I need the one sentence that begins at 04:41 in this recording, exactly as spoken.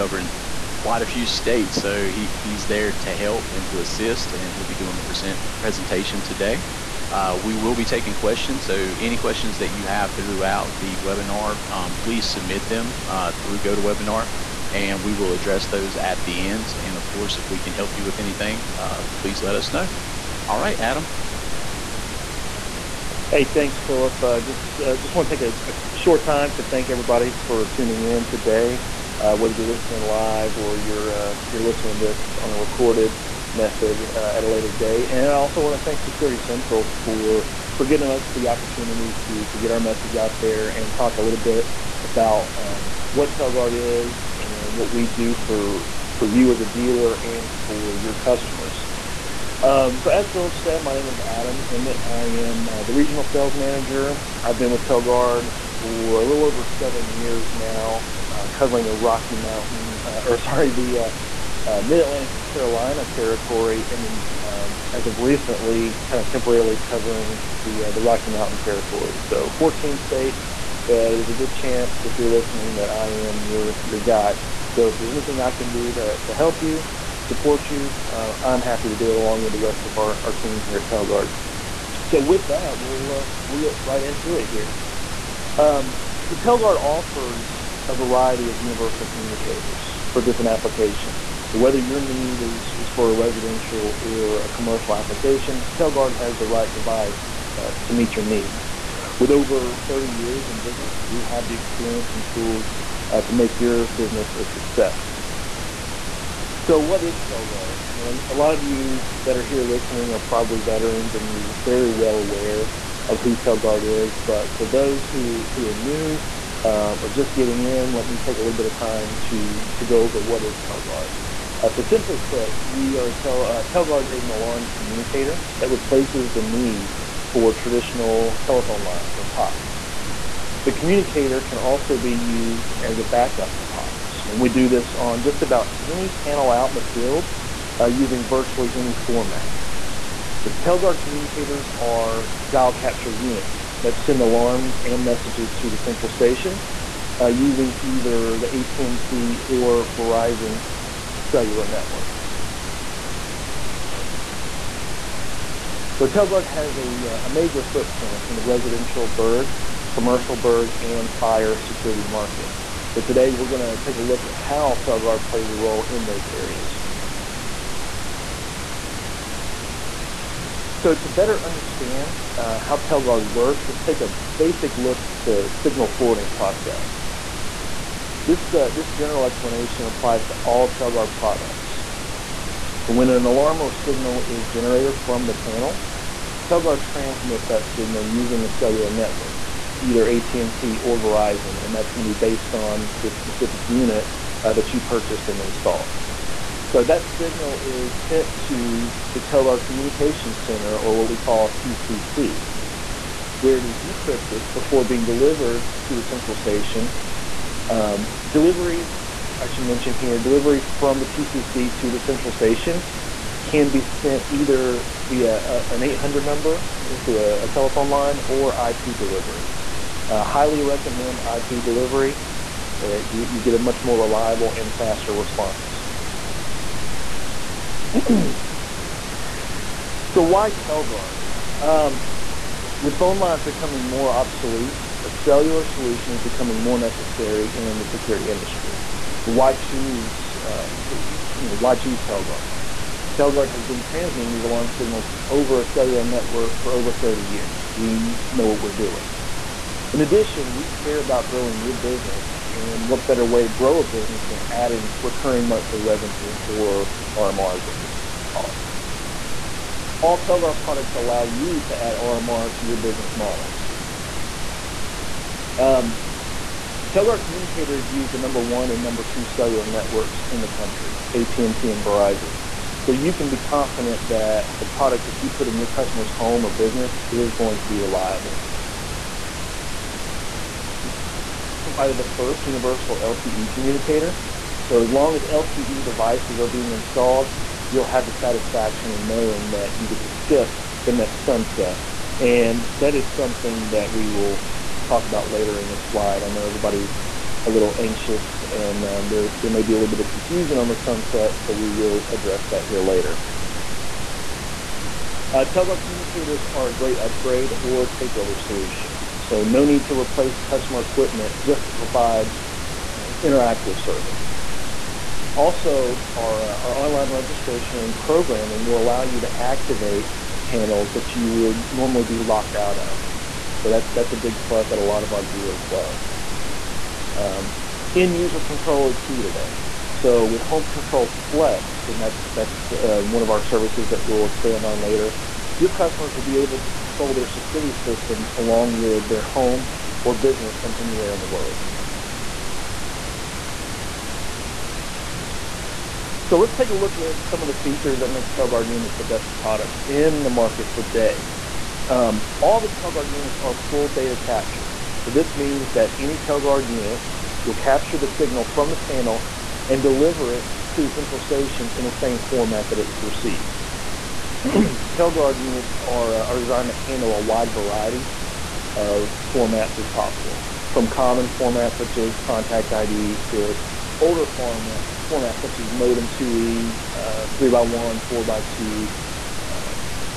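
Provided the first universal LTE communicator.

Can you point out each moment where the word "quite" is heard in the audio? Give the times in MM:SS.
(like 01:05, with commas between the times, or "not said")
00:00.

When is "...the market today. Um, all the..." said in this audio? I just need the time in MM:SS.
05:50.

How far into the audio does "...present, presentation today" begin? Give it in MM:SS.
00:05.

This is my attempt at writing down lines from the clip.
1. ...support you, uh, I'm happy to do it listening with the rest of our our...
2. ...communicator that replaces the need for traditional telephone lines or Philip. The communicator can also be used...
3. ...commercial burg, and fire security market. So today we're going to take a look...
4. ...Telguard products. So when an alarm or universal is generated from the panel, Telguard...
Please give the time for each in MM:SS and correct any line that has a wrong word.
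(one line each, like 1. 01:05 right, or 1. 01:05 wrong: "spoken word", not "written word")
1. 01:17 wrong: "along", not "listening"
2. 02:04 wrong: "POTS", not "Philip"
3. 02:39 right
4. 03:00 wrong: "signal", not "universal".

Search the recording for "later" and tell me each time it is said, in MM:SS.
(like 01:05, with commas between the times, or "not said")
00:34, 04:55, 05:02, 05:34.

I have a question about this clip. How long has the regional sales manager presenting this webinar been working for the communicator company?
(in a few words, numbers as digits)
a little over 7 years.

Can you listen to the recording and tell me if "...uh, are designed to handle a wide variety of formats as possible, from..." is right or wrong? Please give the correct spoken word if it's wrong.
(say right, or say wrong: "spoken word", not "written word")
right.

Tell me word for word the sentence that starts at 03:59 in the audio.
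So why choose, uh, you know, why choose Telguard?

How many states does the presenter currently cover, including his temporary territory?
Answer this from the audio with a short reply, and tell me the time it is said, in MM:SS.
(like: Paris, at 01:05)
14, at 01:09.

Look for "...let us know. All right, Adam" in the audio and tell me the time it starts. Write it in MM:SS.
00:19.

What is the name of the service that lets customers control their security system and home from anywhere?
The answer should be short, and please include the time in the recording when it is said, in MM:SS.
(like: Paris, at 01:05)
Home Control Flex, at 05:30.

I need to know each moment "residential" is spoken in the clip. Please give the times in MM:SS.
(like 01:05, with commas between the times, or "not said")
01:33, 02:38.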